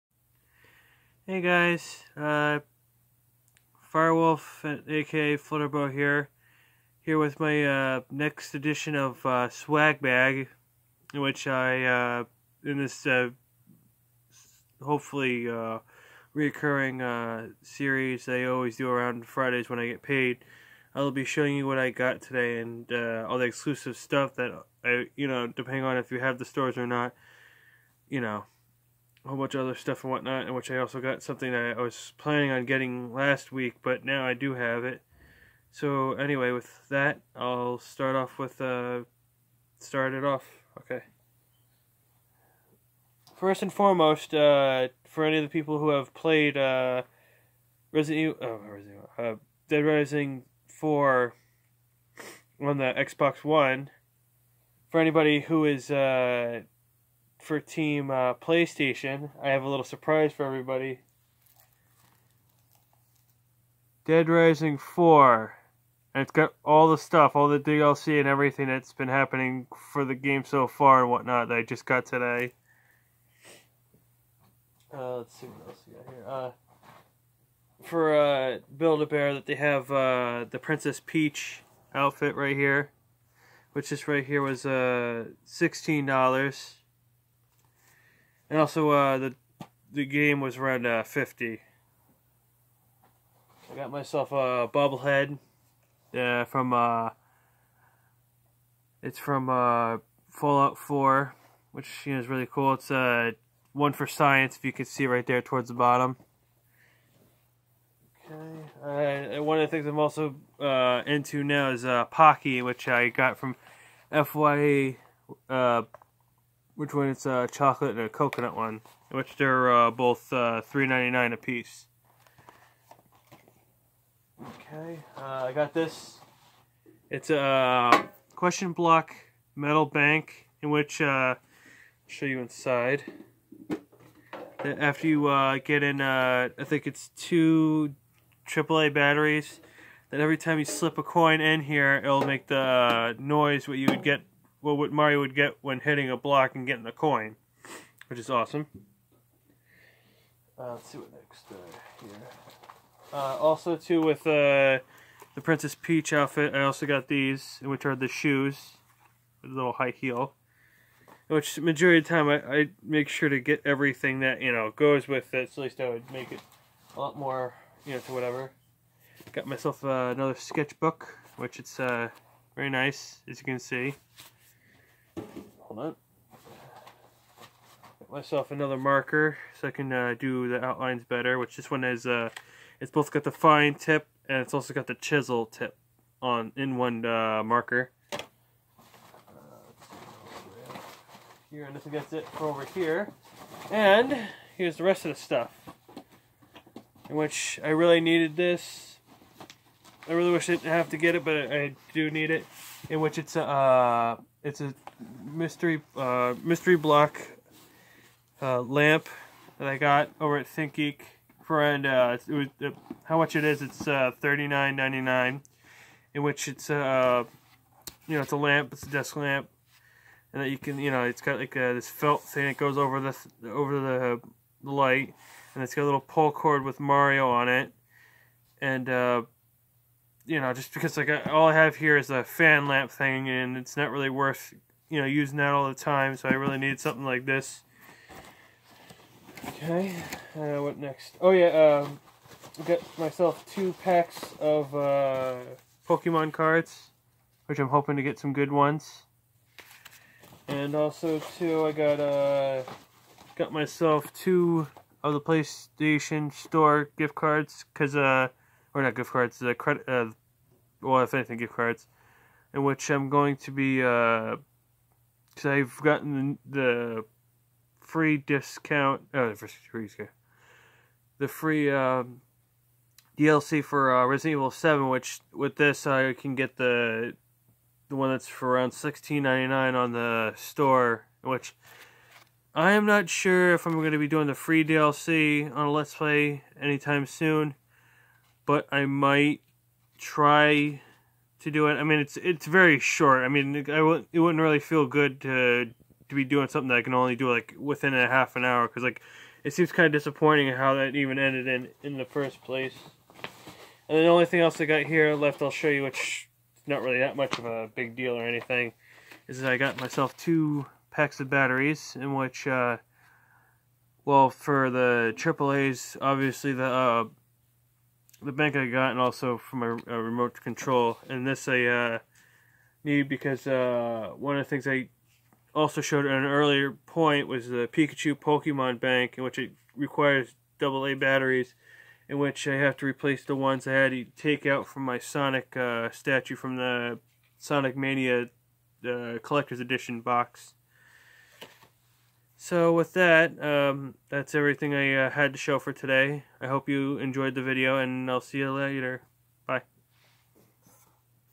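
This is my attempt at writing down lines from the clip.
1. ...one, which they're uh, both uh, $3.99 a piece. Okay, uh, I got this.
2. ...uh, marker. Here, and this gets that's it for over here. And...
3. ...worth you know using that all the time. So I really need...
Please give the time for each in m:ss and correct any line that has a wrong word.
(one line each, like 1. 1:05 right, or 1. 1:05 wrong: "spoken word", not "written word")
1. 1:58 right
2. 3:07 right
3. 3:54 right.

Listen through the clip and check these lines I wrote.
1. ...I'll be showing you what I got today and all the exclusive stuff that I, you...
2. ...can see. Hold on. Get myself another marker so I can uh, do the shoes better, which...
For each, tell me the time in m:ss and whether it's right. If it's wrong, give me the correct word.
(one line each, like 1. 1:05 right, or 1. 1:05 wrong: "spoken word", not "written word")
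1. 0:20 right
2. 2:53 wrong: "outlines", not "shoes".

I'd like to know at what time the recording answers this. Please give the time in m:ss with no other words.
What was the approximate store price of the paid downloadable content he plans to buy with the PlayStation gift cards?
4:38.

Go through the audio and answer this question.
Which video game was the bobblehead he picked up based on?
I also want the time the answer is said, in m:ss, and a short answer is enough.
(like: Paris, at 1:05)
Fallout 4, at 1:40.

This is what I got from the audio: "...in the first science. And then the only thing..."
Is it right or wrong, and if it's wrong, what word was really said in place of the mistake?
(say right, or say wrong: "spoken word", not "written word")
wrong: "place", not "science".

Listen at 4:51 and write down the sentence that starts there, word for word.
I mean, it's it's very short.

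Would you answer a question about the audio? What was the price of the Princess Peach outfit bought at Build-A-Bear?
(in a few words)
$16.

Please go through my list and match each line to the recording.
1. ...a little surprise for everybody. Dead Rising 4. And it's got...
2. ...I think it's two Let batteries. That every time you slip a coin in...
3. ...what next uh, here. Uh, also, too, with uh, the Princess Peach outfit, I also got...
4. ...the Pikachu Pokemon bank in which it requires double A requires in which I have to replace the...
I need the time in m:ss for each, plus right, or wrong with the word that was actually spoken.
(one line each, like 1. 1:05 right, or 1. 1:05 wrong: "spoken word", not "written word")
1. 0:59 right
2. 2:16 wrong: "AAA", not "Let"
3. 2:30 right
4. 5:27 wrong: "batteries", not "requires".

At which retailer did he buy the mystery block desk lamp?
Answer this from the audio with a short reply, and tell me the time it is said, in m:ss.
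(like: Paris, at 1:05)
ThinkGeek, at 3:30.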